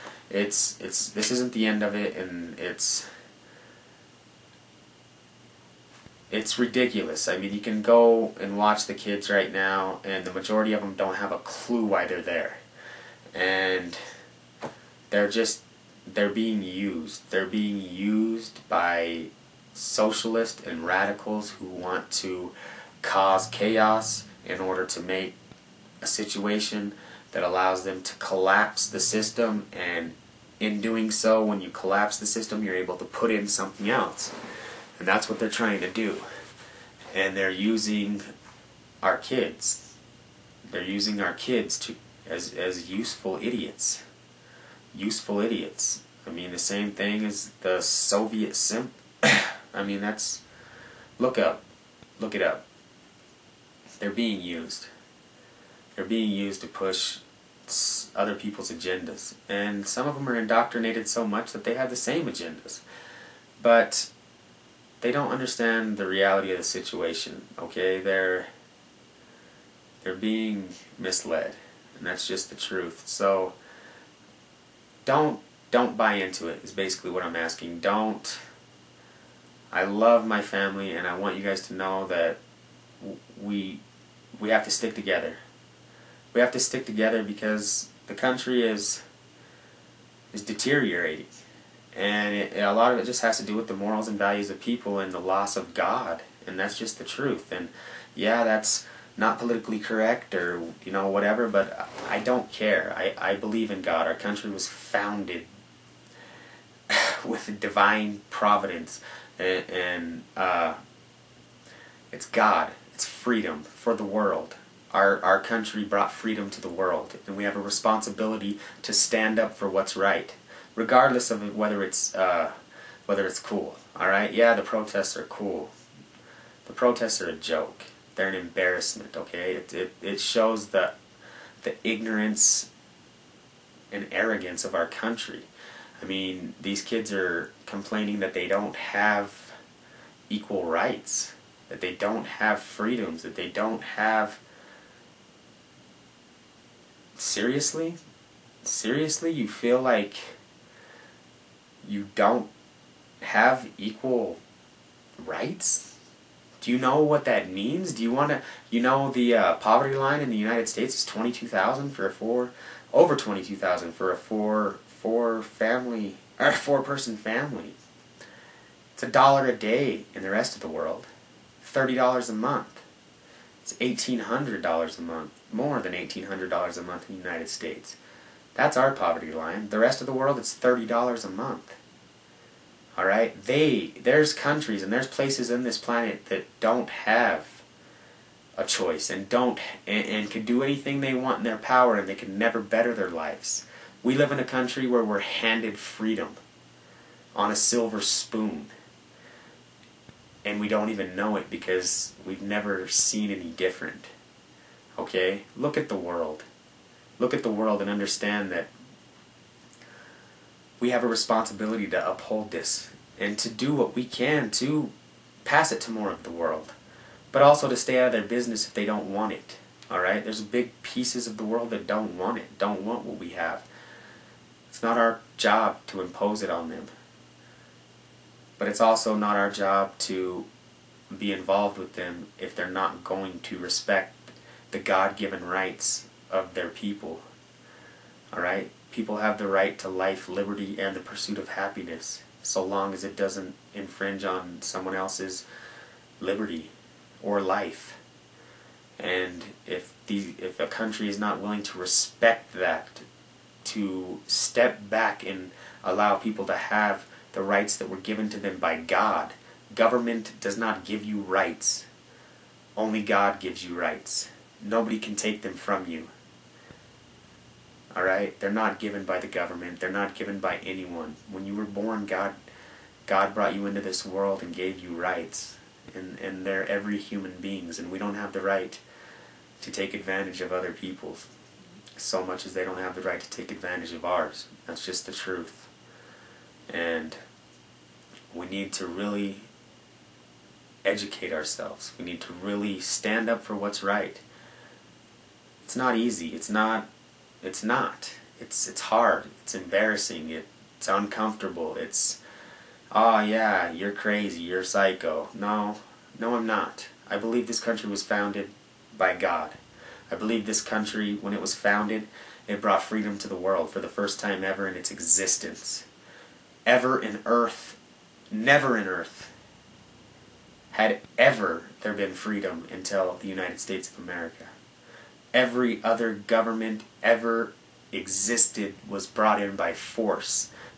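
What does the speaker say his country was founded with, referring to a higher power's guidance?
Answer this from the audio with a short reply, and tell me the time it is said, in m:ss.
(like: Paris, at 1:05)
divine providence, at 1:47.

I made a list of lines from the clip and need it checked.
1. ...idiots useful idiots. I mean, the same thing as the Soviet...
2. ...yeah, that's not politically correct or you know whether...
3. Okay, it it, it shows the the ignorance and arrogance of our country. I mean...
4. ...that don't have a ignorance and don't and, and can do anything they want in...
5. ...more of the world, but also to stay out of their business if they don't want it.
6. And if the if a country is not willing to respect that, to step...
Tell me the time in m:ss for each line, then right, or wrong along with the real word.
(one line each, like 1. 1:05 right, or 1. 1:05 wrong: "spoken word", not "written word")
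1. 0:43 right
2. 1:38 wrong: "whatever", not "whether"
3. 2:09 right
4. 3:06 wrong: "choice", not "ignorance"
5. 3:35 right
6. 4:08 right.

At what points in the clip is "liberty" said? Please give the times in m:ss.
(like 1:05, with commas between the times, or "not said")
4:00, 4:06.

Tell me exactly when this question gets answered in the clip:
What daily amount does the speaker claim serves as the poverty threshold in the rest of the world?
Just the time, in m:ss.
2:49.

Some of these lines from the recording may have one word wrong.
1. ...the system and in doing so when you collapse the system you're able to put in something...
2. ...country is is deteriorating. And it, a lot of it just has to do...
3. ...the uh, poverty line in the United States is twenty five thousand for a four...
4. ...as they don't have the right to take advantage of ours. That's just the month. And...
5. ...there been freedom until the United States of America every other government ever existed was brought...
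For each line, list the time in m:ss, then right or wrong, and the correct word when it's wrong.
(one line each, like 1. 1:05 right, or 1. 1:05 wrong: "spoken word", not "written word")
1. 0:28 right
2. 1:28 right
3. 2:39 wrong: "two", not "five"
4. 4:42 wrong: "truth", not "month"
5. 5:21 right.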